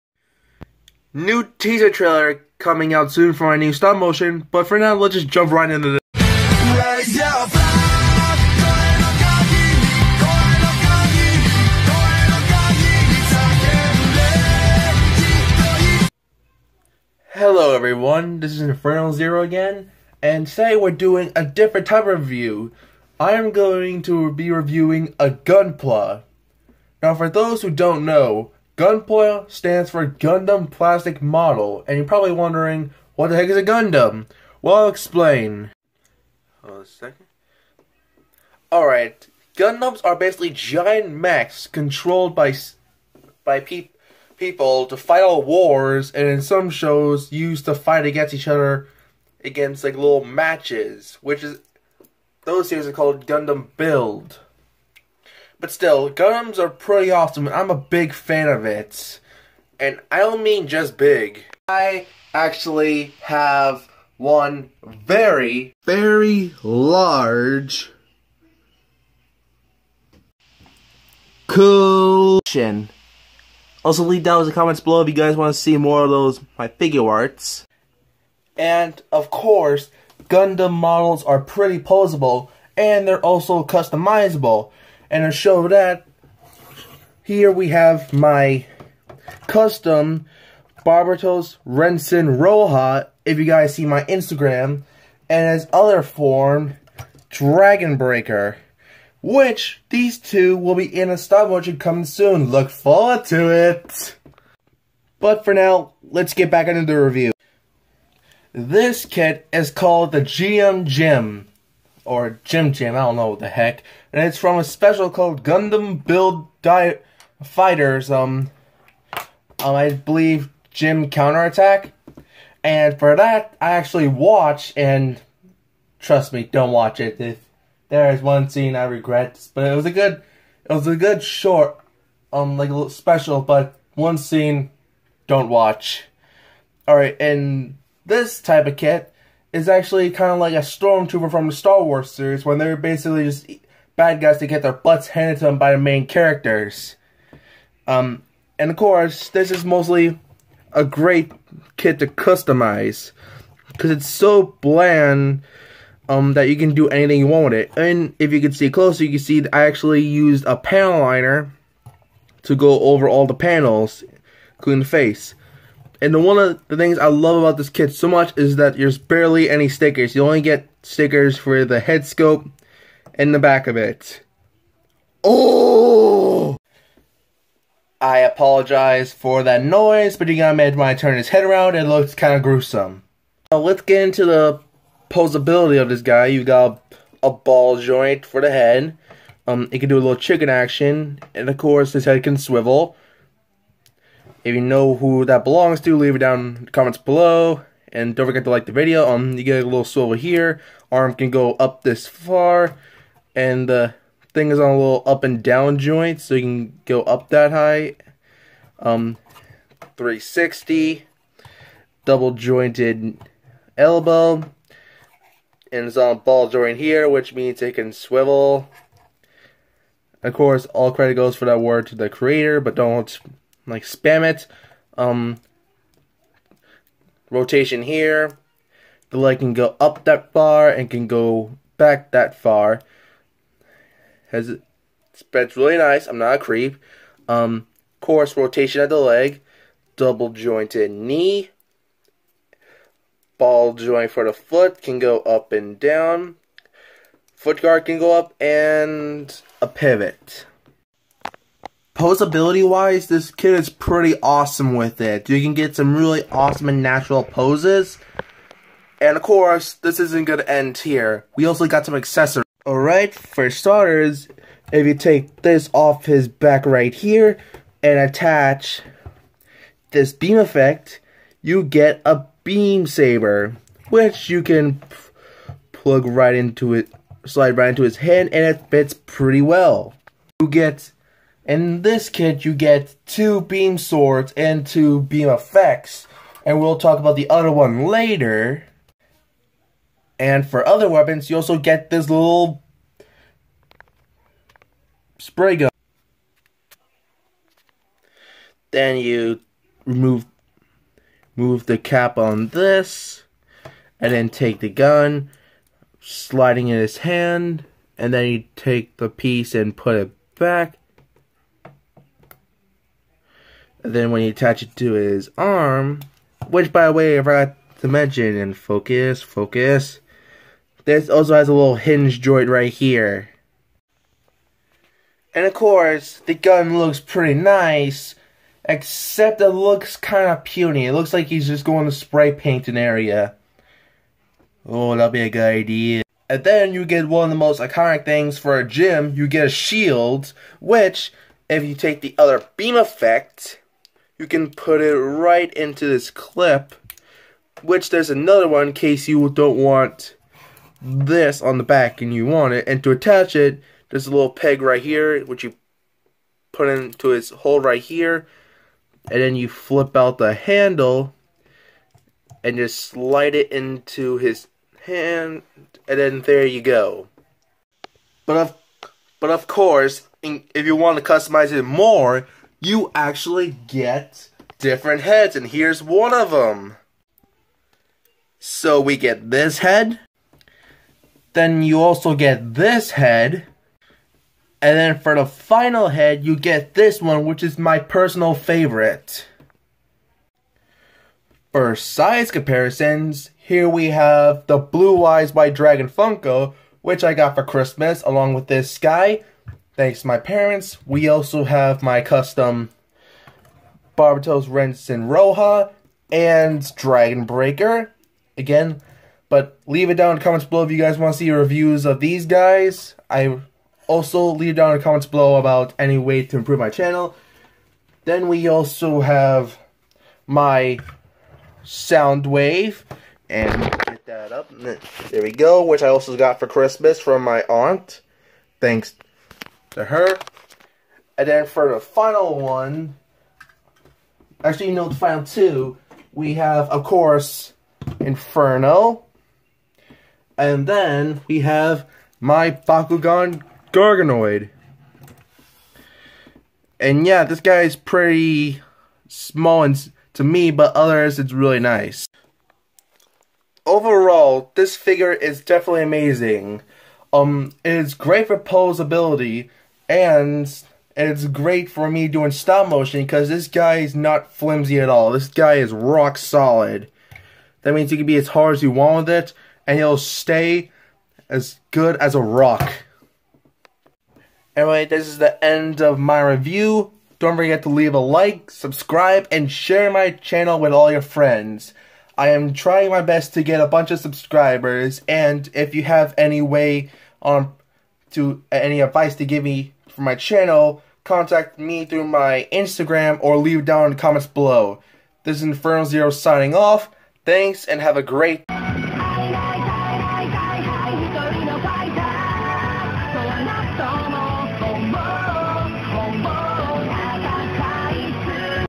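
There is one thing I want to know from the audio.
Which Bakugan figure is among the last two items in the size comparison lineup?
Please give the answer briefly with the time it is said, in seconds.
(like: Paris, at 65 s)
Garganoid, at 443 s.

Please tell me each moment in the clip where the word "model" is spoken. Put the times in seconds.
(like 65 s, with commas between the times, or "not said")
31 s, 80 s.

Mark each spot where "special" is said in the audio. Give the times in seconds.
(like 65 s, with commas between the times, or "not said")
114 s, 132 s.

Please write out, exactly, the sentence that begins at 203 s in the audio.
And the thing is on a little up and down joint.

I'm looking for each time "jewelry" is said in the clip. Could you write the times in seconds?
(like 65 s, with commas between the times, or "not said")
not said.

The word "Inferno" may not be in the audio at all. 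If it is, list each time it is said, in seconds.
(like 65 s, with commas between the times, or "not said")
18 s, 437 s, 495 s.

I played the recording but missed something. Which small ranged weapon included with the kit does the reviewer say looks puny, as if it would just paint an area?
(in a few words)
spray gun.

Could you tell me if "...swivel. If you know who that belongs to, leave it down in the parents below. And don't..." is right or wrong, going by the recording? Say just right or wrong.
wrong.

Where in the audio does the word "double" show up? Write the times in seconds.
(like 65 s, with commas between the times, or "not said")
212 s, 239 s.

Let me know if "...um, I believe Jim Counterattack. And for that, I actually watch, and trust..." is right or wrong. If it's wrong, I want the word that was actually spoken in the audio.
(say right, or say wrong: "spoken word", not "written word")
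right.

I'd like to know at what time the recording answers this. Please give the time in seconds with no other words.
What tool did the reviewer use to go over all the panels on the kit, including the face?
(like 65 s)
160 s.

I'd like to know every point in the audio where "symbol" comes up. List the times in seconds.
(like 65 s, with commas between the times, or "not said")
not said.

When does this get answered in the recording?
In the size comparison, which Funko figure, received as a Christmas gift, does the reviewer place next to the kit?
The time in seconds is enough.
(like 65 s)
394 s.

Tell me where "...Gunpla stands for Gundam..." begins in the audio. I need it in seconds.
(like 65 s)
28 s.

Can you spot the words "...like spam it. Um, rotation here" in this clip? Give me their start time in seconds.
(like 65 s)
223 s.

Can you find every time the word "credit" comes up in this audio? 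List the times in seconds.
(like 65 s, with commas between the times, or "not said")
220 s.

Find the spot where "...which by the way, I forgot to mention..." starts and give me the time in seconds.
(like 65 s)
316 s.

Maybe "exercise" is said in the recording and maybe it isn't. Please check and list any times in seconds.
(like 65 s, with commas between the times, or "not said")
not said.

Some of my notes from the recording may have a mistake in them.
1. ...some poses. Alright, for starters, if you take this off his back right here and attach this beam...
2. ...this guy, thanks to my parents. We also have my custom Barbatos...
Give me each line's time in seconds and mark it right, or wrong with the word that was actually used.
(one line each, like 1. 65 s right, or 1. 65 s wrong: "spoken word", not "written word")
1. 261 s wrong: "accessories", not "poses"
2. 398 s right.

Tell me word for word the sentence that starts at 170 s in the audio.
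You only get stickers for the head scope and the back of it.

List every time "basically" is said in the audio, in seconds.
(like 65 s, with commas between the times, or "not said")
40 s, 142 s.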